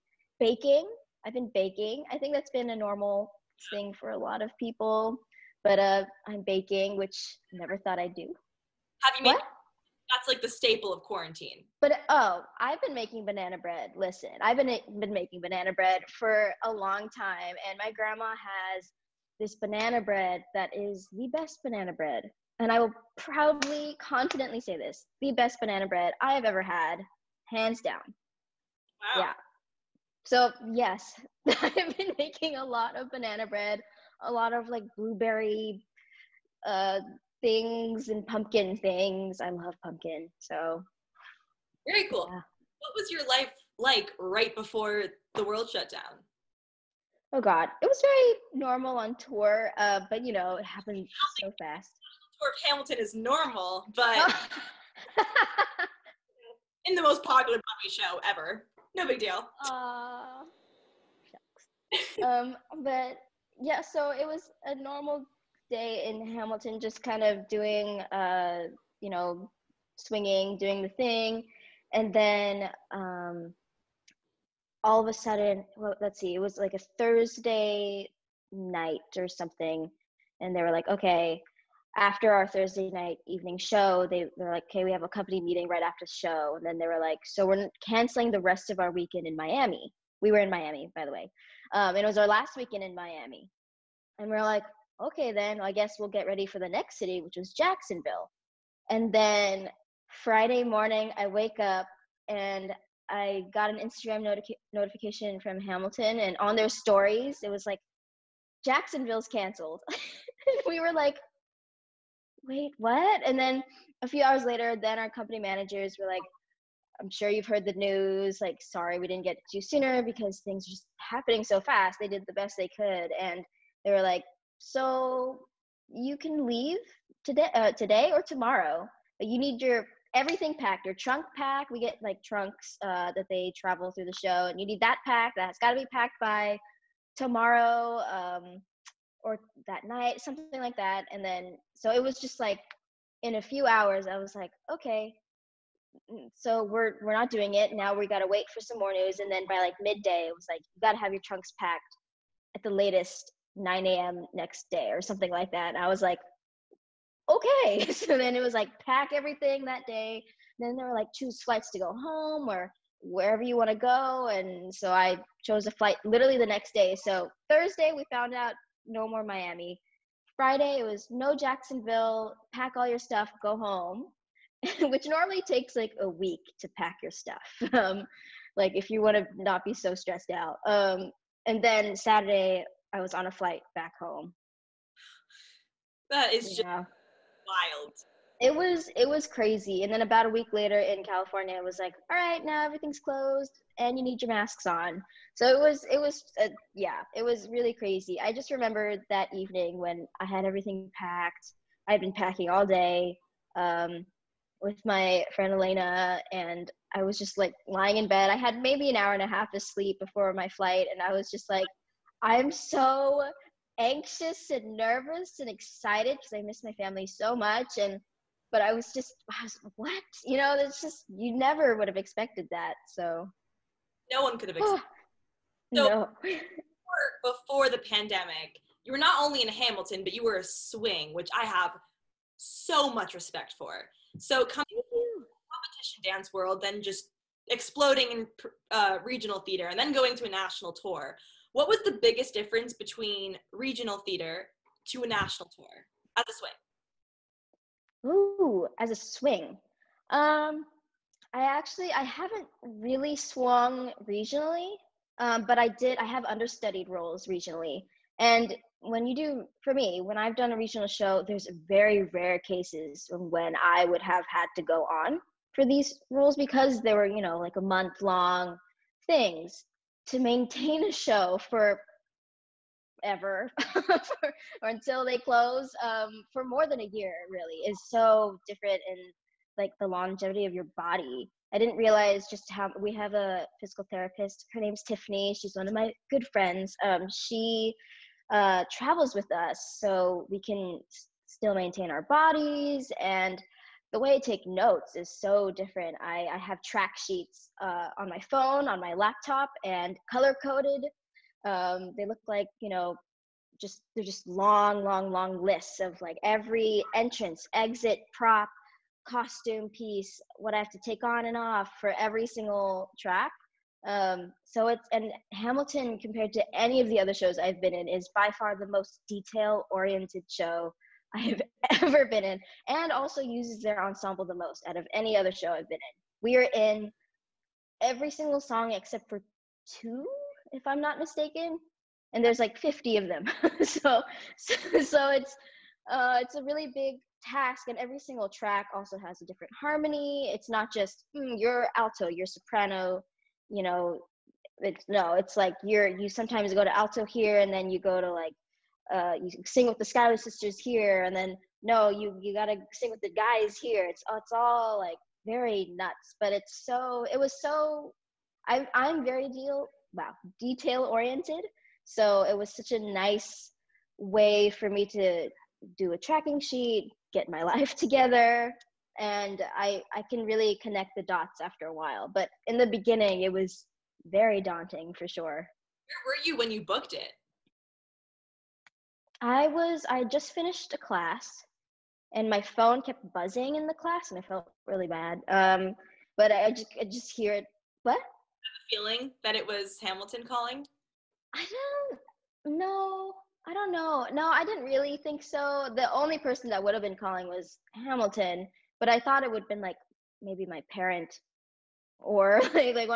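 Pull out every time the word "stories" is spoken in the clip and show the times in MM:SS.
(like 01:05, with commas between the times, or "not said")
01:46.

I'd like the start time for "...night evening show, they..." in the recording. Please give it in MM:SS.
01:22.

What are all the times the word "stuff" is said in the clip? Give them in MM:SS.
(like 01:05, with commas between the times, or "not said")
02:52, 02:57.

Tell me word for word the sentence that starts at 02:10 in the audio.
Your trunk pack, we get like trunks uh, that they travel through the show, and you need that pack.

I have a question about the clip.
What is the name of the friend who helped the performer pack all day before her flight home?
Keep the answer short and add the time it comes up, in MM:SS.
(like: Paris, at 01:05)
Elena, at 03:25.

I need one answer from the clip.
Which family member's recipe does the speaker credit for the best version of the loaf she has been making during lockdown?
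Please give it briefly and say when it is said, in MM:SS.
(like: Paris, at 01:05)
Grandma, at 00:17.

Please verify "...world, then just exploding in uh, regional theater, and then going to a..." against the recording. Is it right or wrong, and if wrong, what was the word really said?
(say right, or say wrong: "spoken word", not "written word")
right.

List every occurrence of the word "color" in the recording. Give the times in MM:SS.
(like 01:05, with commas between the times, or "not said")
05:00.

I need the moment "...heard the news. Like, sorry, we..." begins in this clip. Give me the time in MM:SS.
01:57.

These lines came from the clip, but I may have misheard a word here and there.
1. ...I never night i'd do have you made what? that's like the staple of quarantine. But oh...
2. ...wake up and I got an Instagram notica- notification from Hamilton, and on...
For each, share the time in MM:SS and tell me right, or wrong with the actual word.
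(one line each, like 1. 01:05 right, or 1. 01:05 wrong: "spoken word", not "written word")
1. 00:07 wrong: "thought", not "night"
2. 01:41 right.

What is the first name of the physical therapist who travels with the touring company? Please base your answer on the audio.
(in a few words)
Tiffany.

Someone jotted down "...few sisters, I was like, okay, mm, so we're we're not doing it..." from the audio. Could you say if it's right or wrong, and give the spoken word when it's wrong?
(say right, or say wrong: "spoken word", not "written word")
wrong: "hours", not "sisters".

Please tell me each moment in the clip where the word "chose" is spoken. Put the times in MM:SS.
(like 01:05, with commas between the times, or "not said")
02:45.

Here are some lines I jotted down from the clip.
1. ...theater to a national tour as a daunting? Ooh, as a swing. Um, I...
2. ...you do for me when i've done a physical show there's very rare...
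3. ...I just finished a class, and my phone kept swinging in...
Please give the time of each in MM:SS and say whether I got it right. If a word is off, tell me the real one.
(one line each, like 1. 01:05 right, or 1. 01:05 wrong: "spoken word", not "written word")
1. 04:03 wrong: "swing", not "daunting"
2. 04:19 wrong: "regional", not "physical"
3. 06:19 wrong: "buzzing", not "swinging".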